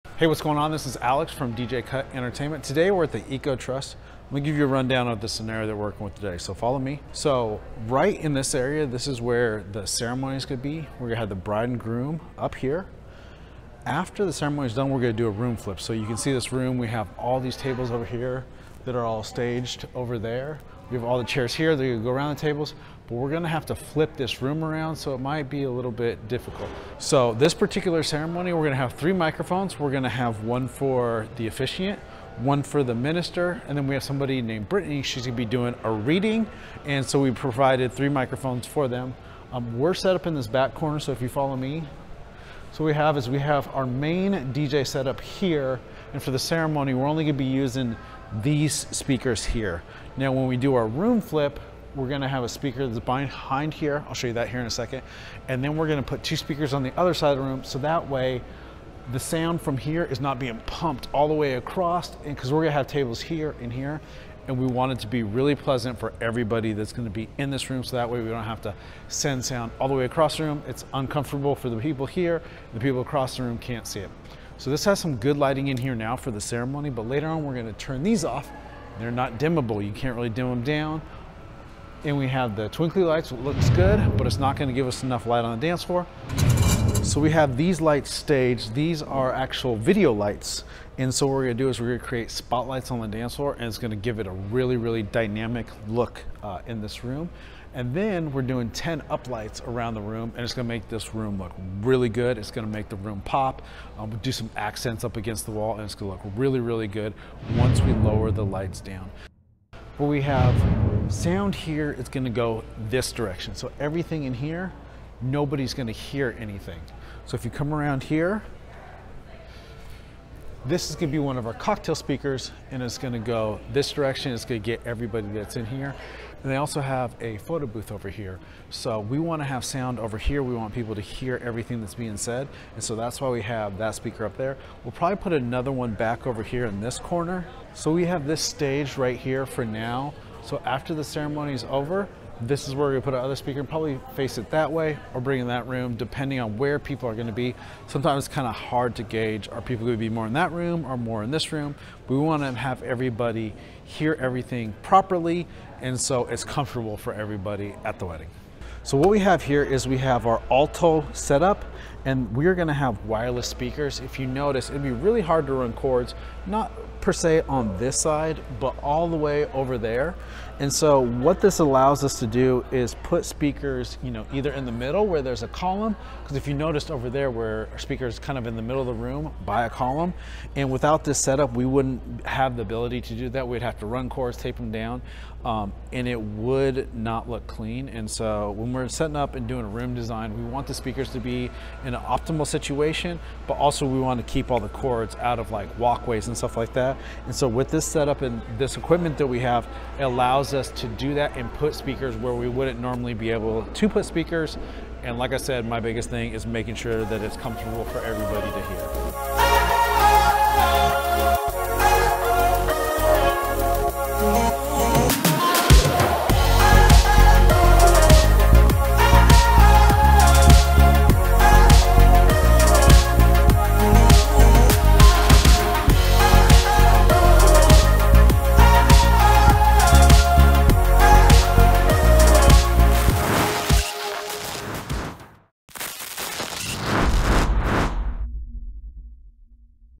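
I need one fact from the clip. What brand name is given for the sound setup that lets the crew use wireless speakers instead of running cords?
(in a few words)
Alto.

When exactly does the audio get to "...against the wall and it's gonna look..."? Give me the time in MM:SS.
01:45.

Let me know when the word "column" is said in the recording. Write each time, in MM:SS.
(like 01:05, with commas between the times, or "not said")
02:55, 02:59.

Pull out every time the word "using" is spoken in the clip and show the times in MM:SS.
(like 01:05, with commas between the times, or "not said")
00:47.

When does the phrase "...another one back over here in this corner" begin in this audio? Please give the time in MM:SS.
02:15.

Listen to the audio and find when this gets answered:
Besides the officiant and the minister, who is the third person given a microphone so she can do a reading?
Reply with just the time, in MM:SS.
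00:34.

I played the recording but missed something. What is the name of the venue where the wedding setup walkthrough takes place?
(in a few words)
Eco Trust.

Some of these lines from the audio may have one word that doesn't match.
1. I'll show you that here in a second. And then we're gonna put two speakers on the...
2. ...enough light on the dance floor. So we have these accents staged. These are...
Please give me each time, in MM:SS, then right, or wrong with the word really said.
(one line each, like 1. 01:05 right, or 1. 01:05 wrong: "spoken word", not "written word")
1. 00:54 right
2. 01:25 wrong: "lights", not "accents".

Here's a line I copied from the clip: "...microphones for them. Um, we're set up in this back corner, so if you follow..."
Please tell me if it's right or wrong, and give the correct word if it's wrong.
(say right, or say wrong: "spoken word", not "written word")
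right.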